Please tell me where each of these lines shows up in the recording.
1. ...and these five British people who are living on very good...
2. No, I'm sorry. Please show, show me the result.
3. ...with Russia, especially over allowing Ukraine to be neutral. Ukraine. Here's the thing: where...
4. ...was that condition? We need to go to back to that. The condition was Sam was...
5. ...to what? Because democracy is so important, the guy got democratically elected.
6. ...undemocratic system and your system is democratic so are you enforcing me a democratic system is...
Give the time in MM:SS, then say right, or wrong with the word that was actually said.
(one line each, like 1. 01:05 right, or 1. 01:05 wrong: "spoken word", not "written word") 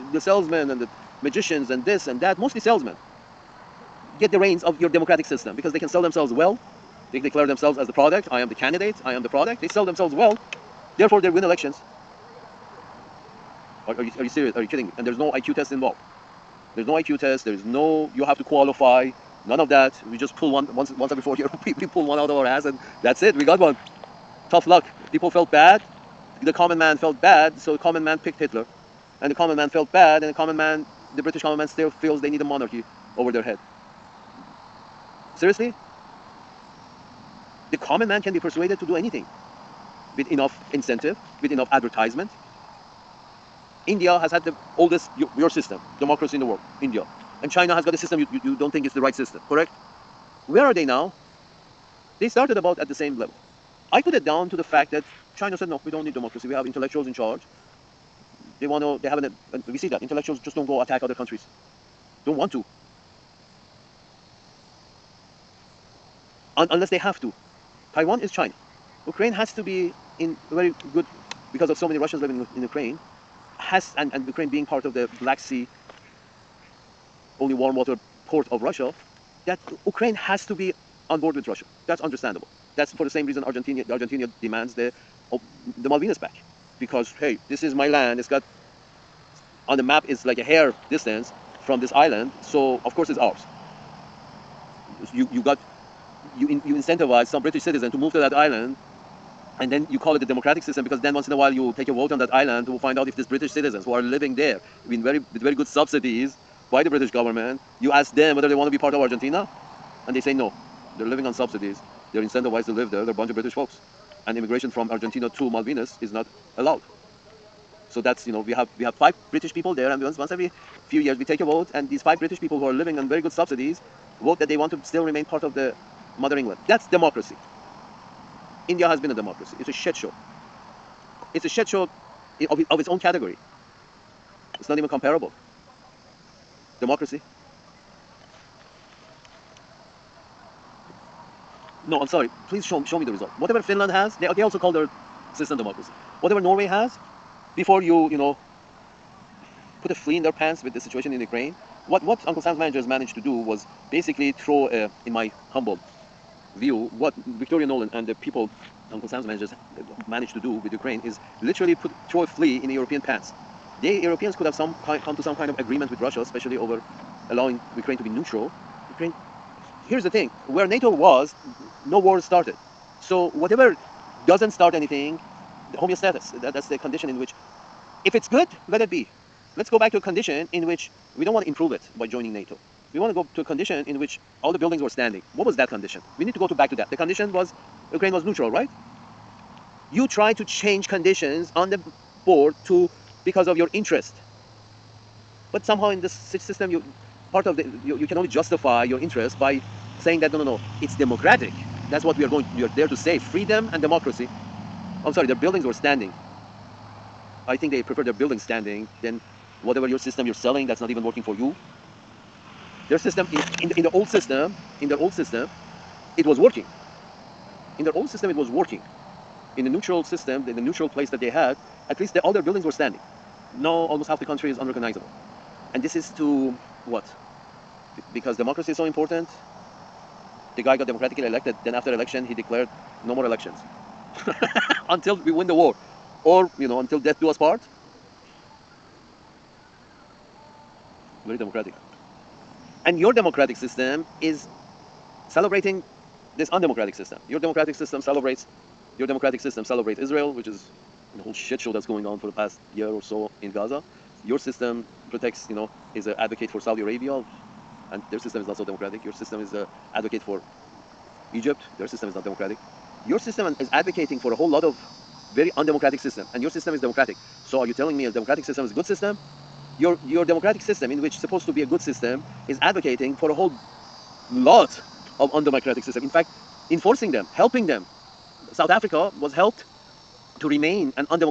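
1. 02:01 right
2. 02:21 right
3. 02:45 right
4. 03:05 wrong: "Ukraine", not "Sam"
5. 03:46 right
6. 04:25 wrong: "telling", not "enforcing".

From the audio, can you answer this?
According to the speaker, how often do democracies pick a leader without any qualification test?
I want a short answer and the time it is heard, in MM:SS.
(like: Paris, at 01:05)
Every 4 years, at 00:20.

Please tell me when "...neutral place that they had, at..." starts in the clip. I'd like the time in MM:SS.
03:40.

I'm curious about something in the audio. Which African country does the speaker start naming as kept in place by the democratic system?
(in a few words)
South Africa.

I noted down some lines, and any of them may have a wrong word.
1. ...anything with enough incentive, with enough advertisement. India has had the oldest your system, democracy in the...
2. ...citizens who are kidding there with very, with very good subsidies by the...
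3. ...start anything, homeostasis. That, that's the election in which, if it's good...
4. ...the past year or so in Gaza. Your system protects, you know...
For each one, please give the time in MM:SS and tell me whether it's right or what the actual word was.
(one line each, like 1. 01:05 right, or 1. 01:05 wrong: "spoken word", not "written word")
1. 00:38 right
2. 01:43 wrong: "living", not "kidding"
3. 02:54 wrong: "condition", not "election"
4. 04:12 right.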